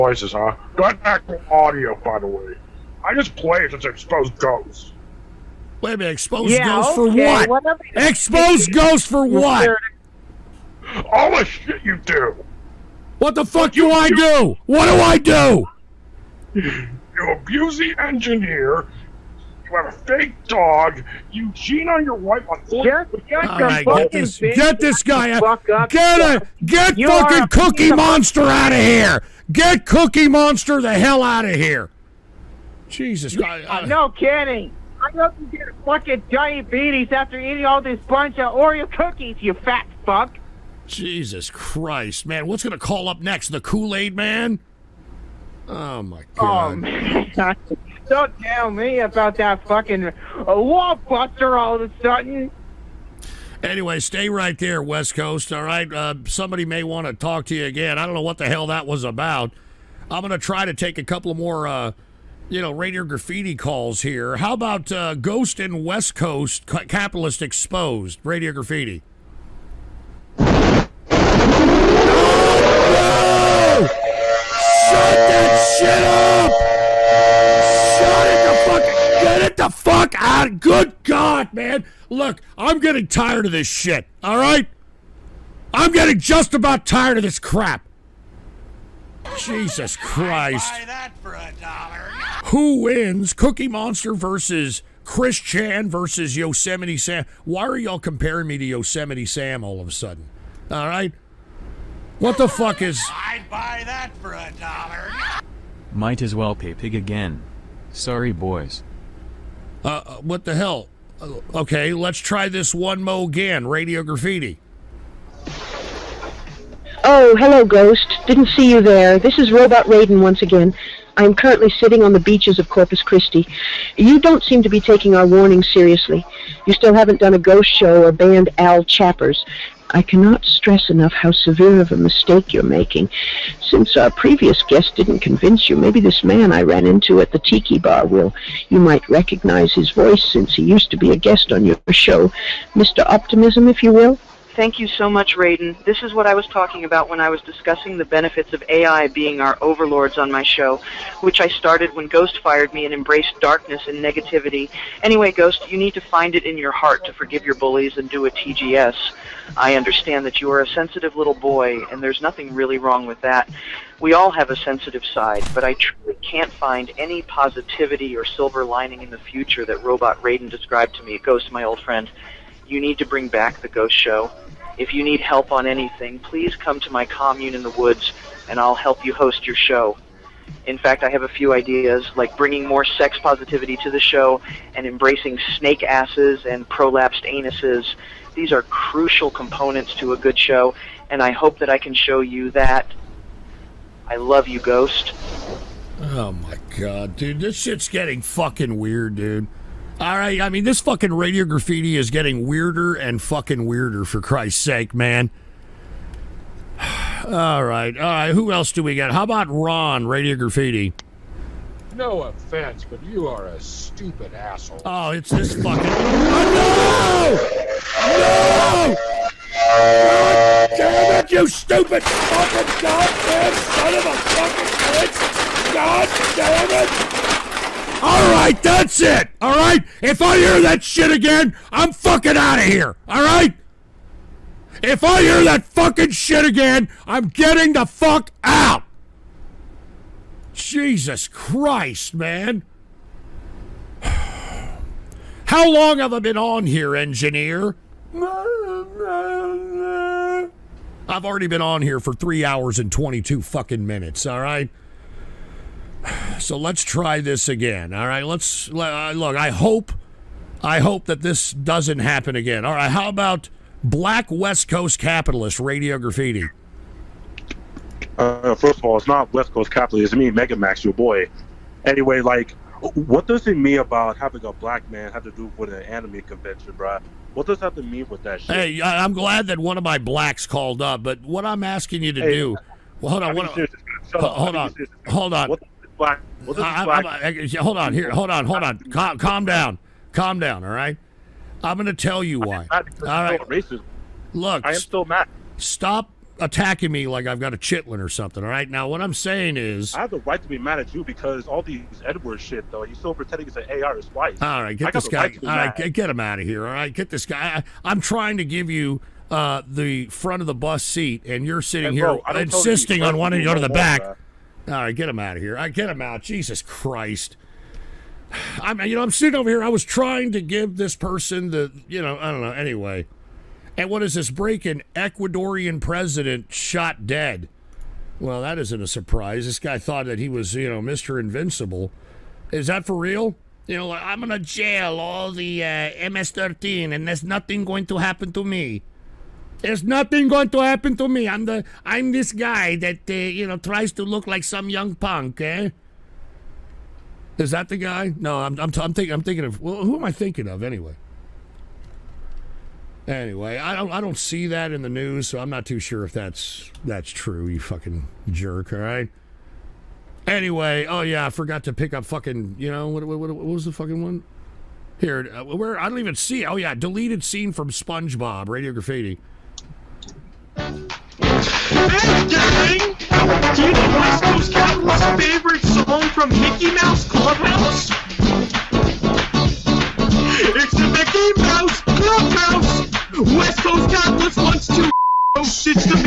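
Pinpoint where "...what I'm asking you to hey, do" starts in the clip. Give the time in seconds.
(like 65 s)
281 s.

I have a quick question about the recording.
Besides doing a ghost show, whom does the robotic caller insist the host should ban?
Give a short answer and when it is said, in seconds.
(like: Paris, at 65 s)
Al Chappers, at 128 s.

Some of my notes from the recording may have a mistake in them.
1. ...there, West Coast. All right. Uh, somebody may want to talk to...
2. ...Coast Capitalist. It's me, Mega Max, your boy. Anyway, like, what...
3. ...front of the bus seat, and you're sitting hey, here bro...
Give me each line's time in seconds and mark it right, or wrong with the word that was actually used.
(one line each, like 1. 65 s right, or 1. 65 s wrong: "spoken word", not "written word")
1. 54 s right
2. 269 s right
3. 310 s right.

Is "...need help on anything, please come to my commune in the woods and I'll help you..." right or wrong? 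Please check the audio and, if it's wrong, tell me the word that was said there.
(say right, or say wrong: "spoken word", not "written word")
right.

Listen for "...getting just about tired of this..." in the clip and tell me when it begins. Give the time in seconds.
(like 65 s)
85 s.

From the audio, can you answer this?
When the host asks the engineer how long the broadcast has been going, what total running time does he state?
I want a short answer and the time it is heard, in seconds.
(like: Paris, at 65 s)
3 hours 22 minutes, at 252 s.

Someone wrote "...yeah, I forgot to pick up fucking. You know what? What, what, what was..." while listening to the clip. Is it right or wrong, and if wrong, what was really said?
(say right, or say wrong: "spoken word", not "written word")
right.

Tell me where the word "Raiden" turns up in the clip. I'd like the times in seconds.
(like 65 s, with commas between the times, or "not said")
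119 s, 145 s, 170 s.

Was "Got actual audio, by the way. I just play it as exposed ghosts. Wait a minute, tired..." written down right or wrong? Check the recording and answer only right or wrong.
wrong.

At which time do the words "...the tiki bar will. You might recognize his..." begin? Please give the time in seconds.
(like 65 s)
137 s.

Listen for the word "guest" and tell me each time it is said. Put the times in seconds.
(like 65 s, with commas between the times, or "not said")
134 s, 141 s.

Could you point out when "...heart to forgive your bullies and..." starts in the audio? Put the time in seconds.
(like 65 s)
156 s.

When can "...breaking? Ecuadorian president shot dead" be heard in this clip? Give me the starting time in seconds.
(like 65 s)
324 s.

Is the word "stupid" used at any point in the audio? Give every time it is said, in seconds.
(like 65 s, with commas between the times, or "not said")
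213 s, 221 s.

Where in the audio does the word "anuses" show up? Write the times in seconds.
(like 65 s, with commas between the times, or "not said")
187 s.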